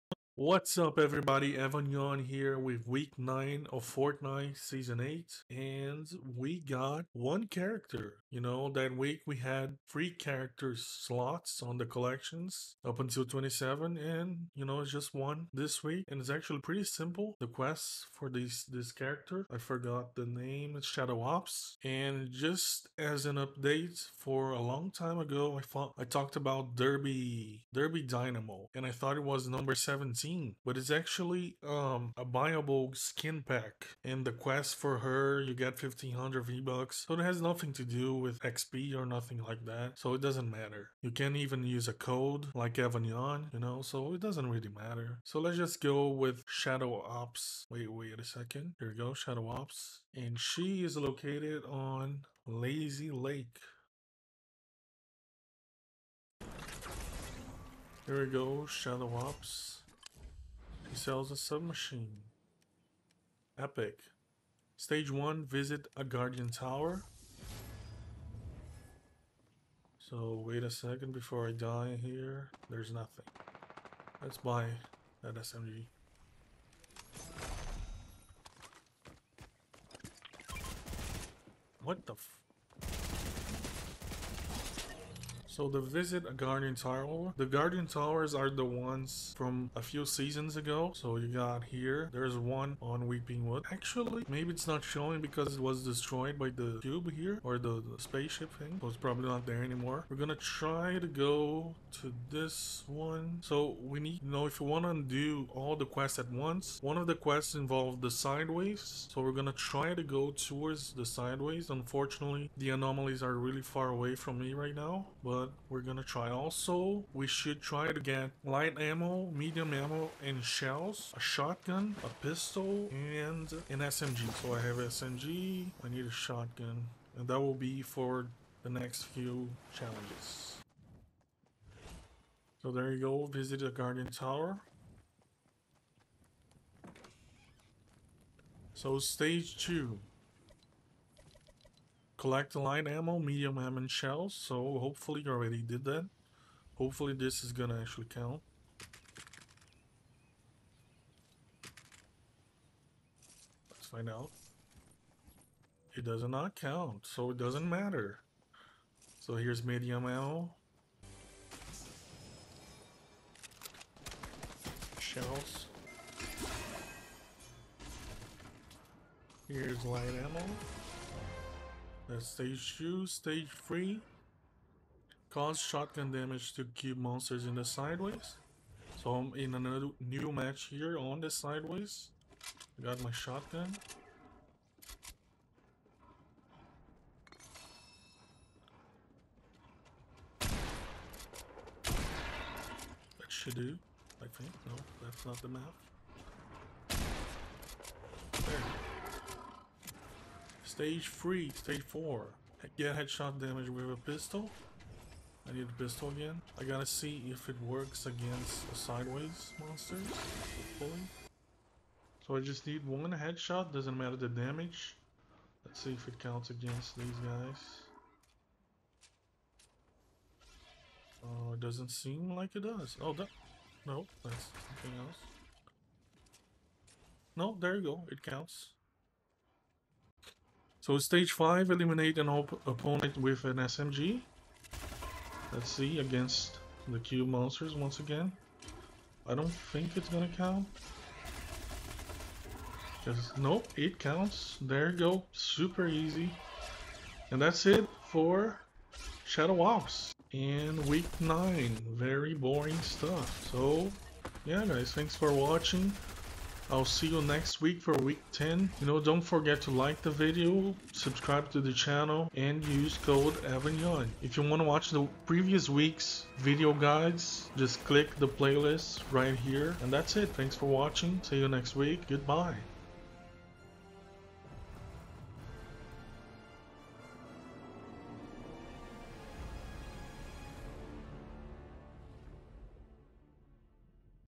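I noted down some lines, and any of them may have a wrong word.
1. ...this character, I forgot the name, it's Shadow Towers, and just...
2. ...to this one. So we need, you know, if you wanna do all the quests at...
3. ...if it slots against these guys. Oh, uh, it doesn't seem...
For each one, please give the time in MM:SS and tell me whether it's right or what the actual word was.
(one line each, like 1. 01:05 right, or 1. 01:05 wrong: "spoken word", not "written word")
1. 00:18 wrong: "Ops", not "Towers"
2. 01:42 right
3. 03:35 wrong: "counts", not "slots".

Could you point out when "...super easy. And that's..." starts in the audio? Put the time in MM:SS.
04:05.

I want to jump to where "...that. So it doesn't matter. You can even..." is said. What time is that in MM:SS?
00:39.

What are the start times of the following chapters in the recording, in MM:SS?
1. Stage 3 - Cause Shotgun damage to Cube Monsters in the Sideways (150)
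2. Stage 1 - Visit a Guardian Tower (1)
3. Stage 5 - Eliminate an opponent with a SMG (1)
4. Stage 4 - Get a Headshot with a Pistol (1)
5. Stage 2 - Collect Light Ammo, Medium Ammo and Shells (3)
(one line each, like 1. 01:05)
1. 02:54
2. 01:03
3. 03:50
4. 03:21
5. 02:21.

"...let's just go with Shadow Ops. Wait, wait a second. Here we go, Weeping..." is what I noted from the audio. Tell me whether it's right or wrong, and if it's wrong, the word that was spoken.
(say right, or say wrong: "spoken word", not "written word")
wrong: "Shadow", not "Weeping".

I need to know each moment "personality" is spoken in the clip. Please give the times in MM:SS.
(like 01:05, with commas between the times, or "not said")
not said.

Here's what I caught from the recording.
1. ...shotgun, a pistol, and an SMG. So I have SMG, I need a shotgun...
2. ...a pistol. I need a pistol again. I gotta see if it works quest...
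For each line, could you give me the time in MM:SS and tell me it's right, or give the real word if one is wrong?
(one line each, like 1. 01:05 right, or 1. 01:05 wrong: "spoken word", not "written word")
1. 02:01 right
2. 03:23 wrong: "against", not "quest".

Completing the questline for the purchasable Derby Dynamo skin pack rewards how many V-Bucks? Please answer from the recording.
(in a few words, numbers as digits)
1500.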